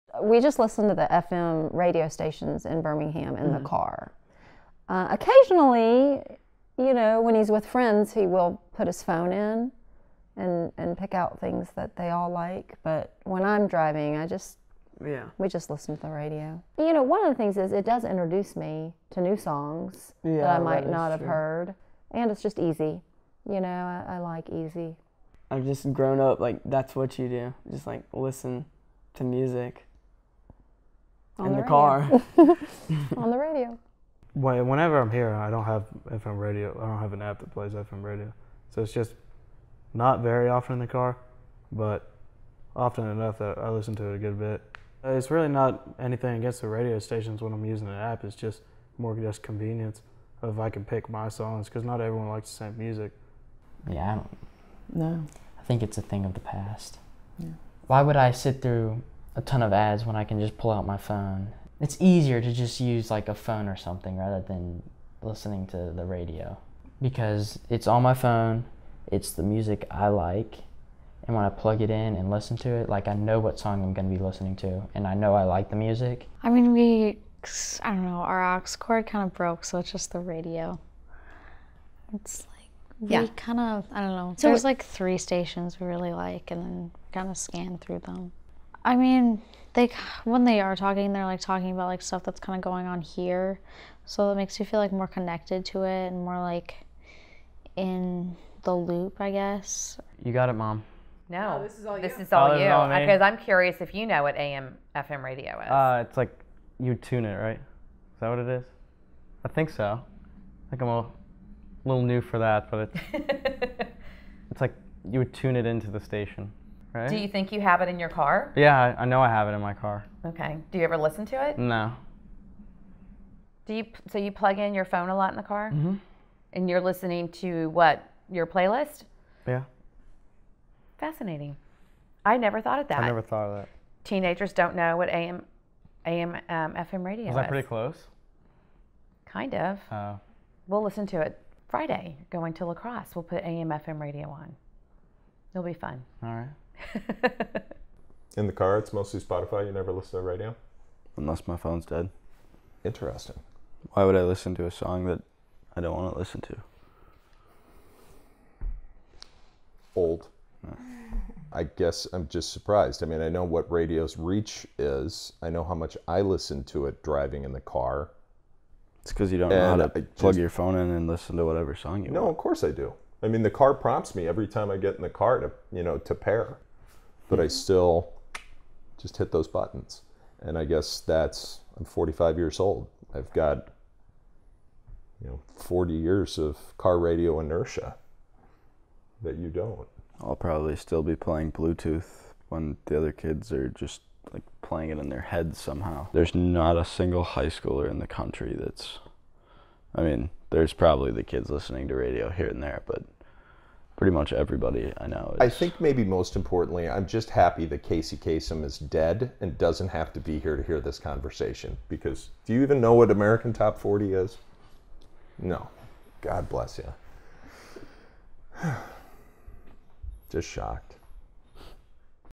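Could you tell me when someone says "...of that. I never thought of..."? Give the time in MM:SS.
02:12.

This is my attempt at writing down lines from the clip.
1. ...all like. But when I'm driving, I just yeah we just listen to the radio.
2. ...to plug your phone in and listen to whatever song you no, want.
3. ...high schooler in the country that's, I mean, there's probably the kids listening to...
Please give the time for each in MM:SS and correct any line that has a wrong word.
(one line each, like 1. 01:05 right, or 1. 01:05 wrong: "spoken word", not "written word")
1. 00:12 right
2. 02:49 right
3. 03:17 right.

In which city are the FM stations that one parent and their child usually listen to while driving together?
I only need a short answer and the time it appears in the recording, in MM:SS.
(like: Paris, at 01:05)
Birmingham, at 00:02.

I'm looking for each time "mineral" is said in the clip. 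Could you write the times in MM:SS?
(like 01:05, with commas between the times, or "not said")
not said.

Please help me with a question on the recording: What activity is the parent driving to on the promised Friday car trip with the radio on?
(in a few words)
lacrosse.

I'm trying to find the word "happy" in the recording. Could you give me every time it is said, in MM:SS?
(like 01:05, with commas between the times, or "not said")
03:27.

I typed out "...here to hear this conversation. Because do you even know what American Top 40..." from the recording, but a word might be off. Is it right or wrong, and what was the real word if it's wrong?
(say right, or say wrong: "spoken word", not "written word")
right.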